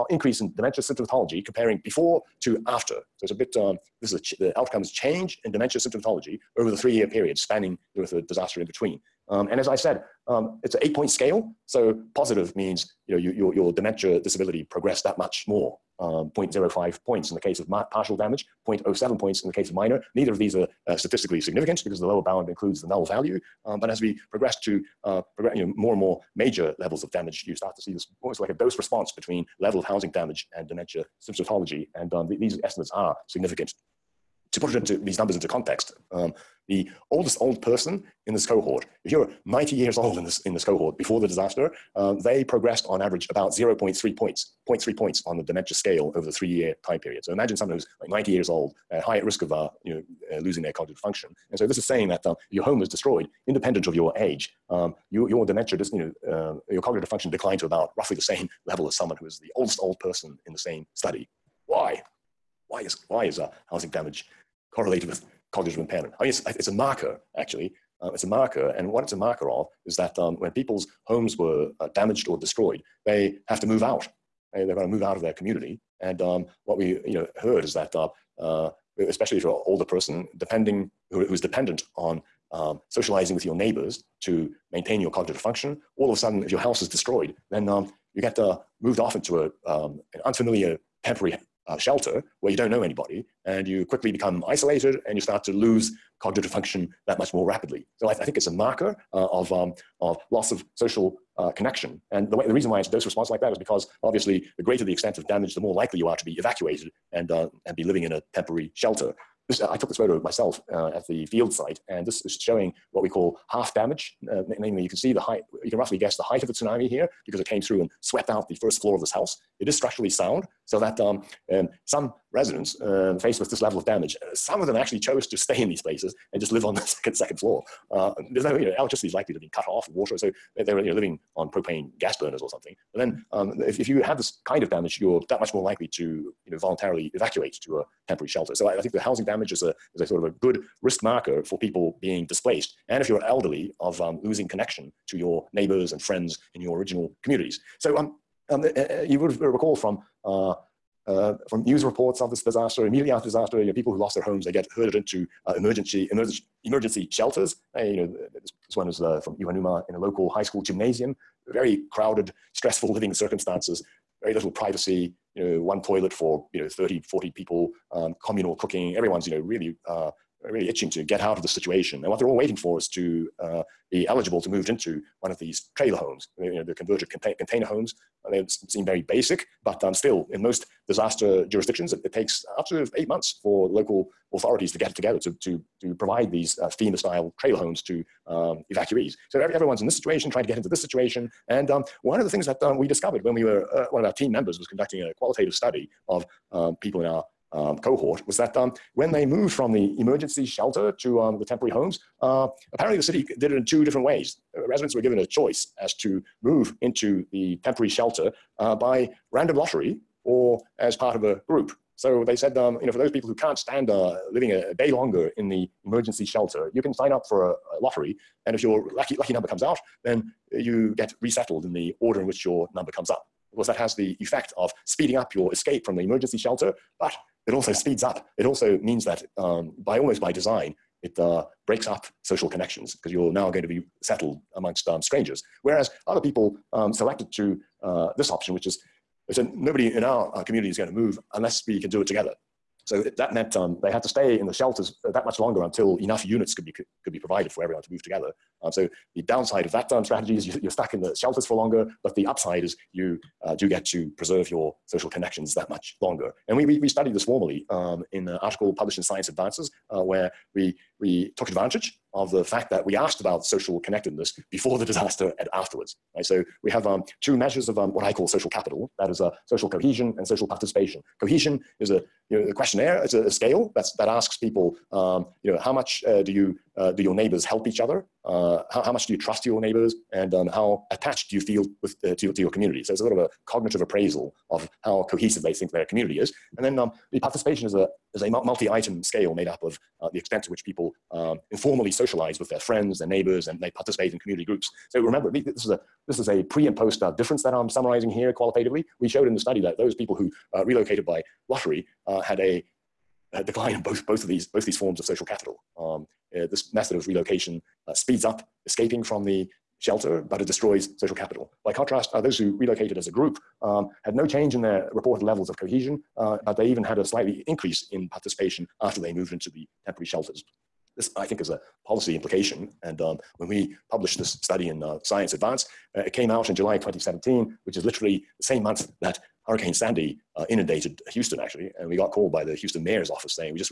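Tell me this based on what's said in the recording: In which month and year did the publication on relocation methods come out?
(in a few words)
July 2017.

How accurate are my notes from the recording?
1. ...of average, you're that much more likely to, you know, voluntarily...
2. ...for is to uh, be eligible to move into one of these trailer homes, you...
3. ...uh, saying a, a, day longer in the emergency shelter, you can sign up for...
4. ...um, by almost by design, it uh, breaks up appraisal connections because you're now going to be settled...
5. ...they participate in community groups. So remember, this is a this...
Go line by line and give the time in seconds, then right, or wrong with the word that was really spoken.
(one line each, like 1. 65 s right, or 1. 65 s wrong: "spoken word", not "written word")
1. 134 s wrong: "damage", not "average"
2. 172 s right
3. 213 s wrong: "living", not "saying"
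4. 229 s wrong: "social", not "appraisal"
5. 293 s right.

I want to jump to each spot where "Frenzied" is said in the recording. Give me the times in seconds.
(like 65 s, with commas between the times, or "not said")
not said.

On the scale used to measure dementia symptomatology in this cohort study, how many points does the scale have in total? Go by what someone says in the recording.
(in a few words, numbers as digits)
8.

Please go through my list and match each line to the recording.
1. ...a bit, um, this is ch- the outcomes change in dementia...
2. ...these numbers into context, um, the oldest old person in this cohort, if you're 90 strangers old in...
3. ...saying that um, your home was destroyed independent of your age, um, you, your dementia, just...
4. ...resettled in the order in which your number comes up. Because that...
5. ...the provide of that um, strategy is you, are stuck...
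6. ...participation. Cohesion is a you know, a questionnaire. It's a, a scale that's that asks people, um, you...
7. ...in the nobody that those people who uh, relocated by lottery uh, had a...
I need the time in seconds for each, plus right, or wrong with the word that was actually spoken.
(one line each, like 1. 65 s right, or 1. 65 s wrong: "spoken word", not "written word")
1. 3 s right
2. 35 s wrong: "years", not "strangers"
3. 51 s right
4. 221 s right
5. 249 s wrong: "downside", not "provide"
6. 270 s right
7. 299 s wrong: "study", not "nobody".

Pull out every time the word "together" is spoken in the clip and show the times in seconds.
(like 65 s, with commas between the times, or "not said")
184 s, 242 s, 248 s.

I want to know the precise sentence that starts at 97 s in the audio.
So I, th- I think it's a marker uh, of, um, of loss of social uh, connection.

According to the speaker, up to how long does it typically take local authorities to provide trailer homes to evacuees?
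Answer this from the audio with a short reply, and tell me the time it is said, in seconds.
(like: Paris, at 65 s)
8 months, at 182 s.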